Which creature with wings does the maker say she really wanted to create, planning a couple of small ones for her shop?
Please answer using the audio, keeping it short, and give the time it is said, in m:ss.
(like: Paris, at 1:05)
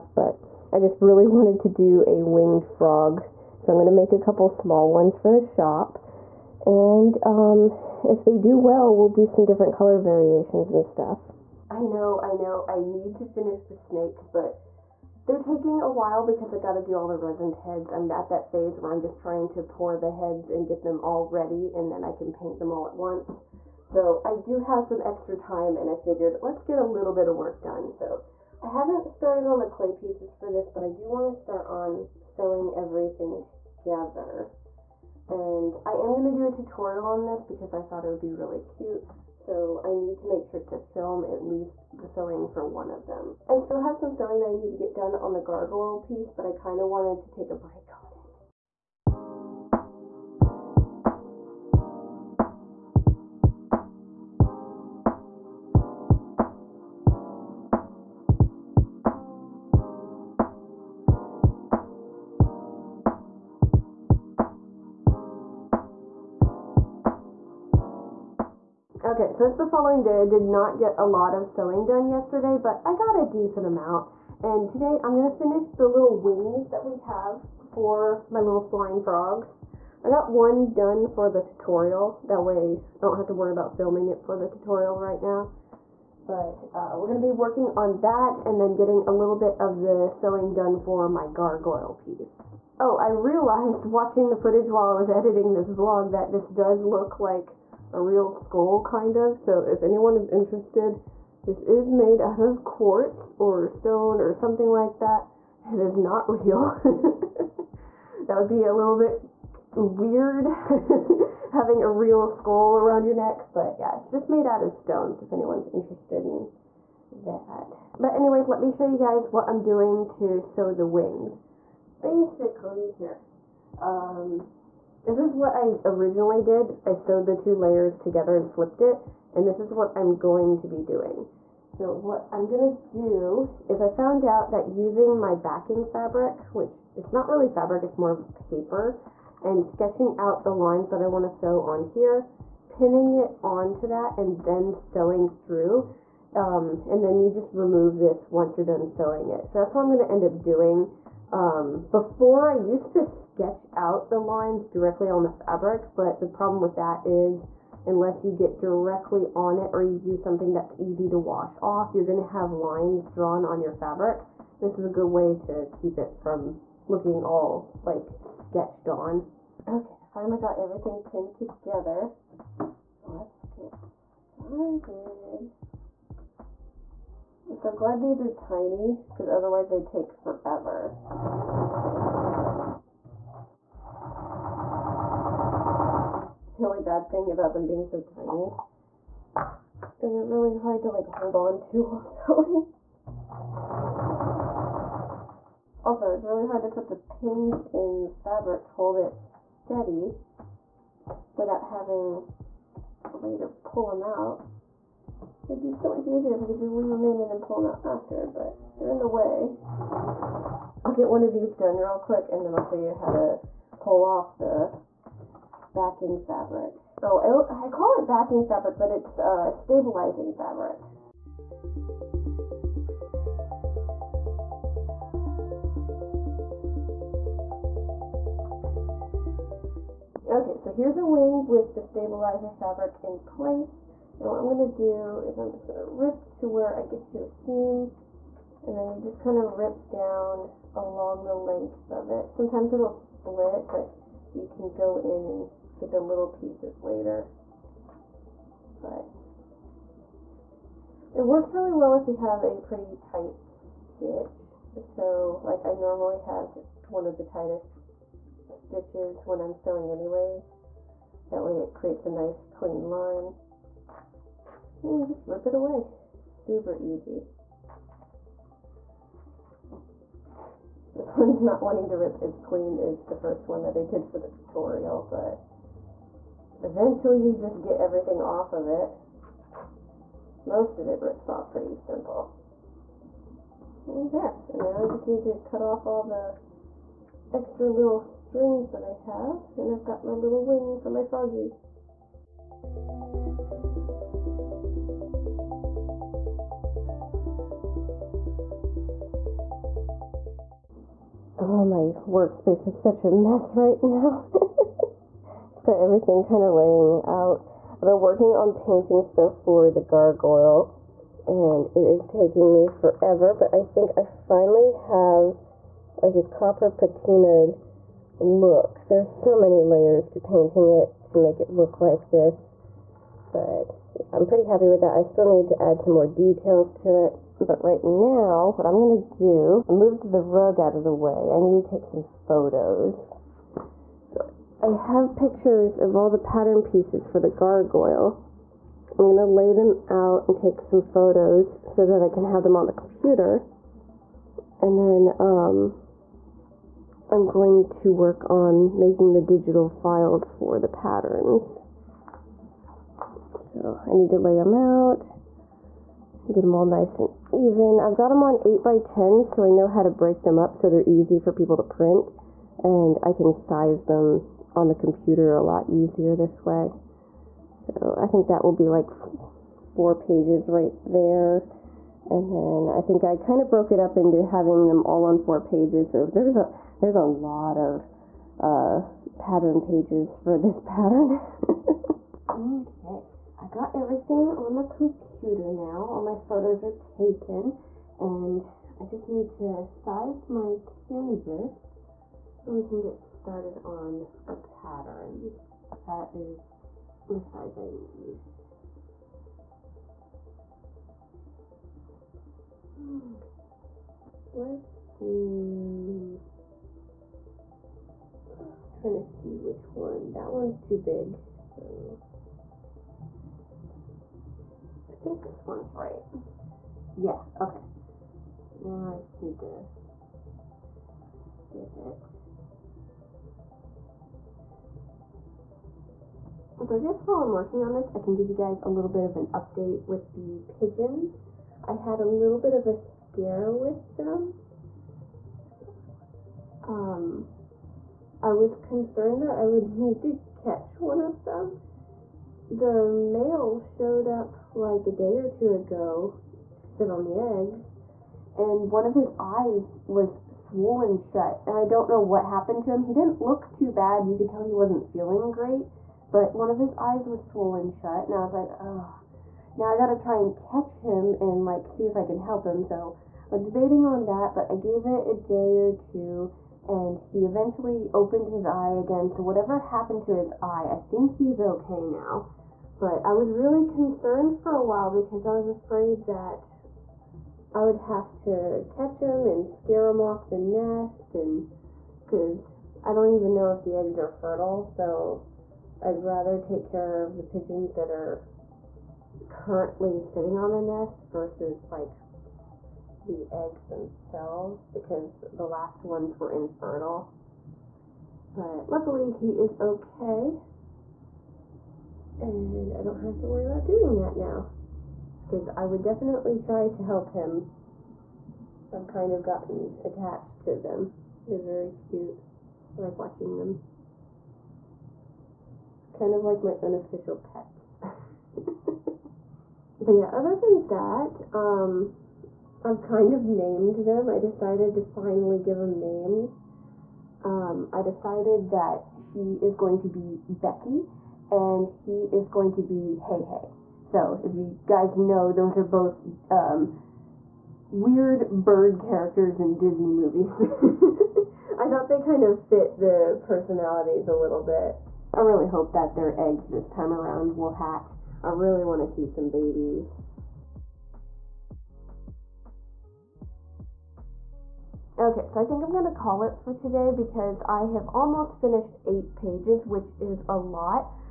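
winged frog, at 0:02.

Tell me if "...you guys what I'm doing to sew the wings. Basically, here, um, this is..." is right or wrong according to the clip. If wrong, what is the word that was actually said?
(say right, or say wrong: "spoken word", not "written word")
right.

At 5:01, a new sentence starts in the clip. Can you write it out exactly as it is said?
Oh, my workspace is such a mess right now.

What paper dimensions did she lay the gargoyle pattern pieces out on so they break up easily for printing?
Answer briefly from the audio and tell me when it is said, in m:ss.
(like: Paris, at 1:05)
8 by 10, at 5:58.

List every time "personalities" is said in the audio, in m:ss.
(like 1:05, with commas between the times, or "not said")
9:03.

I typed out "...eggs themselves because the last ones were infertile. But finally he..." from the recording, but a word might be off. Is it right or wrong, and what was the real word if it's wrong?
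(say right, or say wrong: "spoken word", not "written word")
wrong: "luckily", not "finally".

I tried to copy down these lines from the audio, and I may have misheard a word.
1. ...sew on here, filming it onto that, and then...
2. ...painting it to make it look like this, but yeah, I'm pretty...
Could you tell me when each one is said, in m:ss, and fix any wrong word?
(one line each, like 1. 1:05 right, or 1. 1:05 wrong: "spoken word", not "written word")
1. 2:21 wrong: "pinning", not "filming"
2. 5:20 right.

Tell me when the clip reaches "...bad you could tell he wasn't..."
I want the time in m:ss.
7:33.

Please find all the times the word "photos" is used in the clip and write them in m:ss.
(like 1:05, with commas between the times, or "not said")
5:32, 5:40, 6:26.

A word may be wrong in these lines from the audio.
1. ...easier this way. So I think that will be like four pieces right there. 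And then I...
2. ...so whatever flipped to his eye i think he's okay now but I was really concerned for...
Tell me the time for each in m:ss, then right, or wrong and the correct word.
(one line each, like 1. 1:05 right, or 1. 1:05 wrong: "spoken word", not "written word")
1. 6:05 wrong: "pages", not "pieces"
2. 7:49 wrong: "happened", not "flipped".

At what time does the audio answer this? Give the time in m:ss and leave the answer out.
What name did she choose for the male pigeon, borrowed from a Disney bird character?
8:52.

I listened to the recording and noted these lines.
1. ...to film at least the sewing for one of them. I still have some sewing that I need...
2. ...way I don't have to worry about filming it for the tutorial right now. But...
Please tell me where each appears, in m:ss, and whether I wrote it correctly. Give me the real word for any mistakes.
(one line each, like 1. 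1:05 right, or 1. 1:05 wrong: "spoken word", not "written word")
1. 0:40 right
2. 1:22 right.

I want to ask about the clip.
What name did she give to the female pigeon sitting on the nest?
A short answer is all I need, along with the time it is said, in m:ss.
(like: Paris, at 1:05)
Becky, at 8:50.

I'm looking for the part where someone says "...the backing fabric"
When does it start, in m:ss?
3:34.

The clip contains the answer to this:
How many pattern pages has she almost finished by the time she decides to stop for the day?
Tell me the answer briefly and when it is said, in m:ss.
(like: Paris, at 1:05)
8, at 9:18.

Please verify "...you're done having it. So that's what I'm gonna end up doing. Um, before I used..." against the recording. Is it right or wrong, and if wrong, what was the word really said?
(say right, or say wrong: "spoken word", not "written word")
wrong: "sewing", not "having".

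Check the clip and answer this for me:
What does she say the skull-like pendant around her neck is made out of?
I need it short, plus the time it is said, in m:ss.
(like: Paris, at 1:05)
quartz, at 1:42.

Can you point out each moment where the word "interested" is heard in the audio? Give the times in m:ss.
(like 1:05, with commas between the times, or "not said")
1:40, 1:55.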